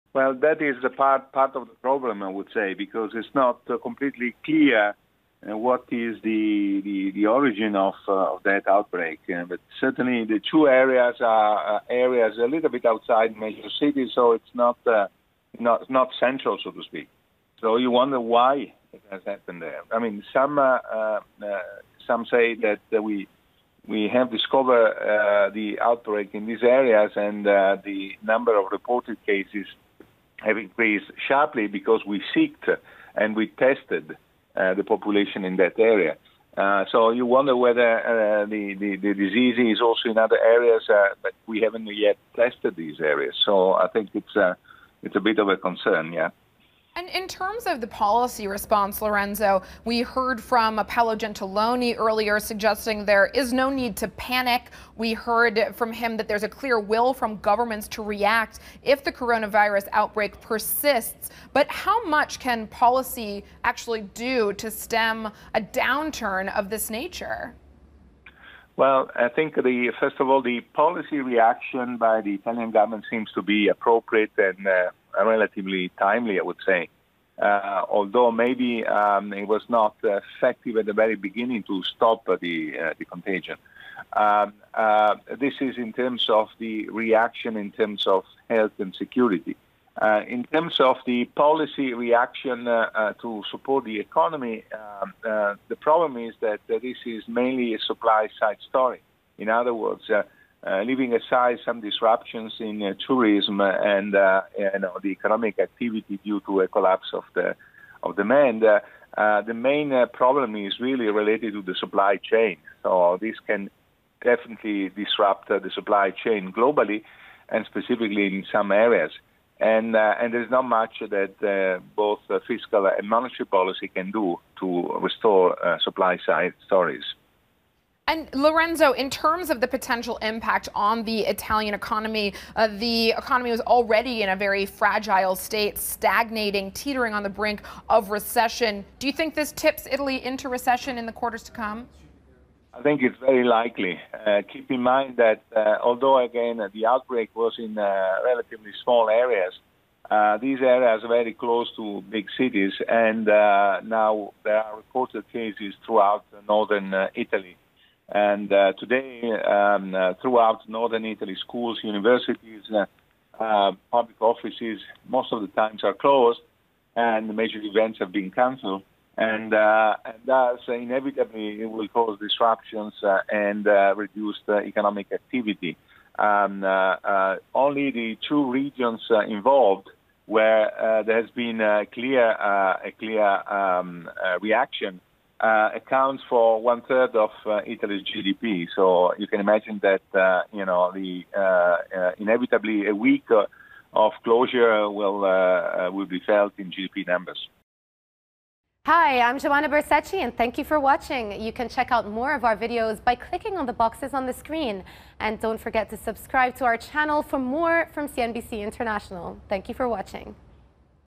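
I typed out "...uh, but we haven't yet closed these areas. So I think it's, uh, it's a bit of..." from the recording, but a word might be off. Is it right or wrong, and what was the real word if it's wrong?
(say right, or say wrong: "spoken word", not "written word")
wrong: "tested", not "closed".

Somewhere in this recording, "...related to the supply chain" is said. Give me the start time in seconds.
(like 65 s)
111 s.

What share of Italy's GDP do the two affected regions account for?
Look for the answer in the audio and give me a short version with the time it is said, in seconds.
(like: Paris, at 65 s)
one third, at 186 s.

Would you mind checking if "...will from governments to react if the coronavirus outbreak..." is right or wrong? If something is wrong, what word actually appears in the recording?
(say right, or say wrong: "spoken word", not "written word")
right.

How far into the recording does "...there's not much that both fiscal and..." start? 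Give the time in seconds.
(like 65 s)
120 s.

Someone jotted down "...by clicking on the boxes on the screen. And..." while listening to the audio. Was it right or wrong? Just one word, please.
right.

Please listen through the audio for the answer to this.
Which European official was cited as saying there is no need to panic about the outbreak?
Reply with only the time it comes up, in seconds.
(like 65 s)
50 s.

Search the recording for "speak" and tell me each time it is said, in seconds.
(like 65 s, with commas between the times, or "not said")
16 s.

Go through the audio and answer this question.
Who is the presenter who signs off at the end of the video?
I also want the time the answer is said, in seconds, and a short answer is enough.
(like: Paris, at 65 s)
Joumanna Bercetche, at 199 s.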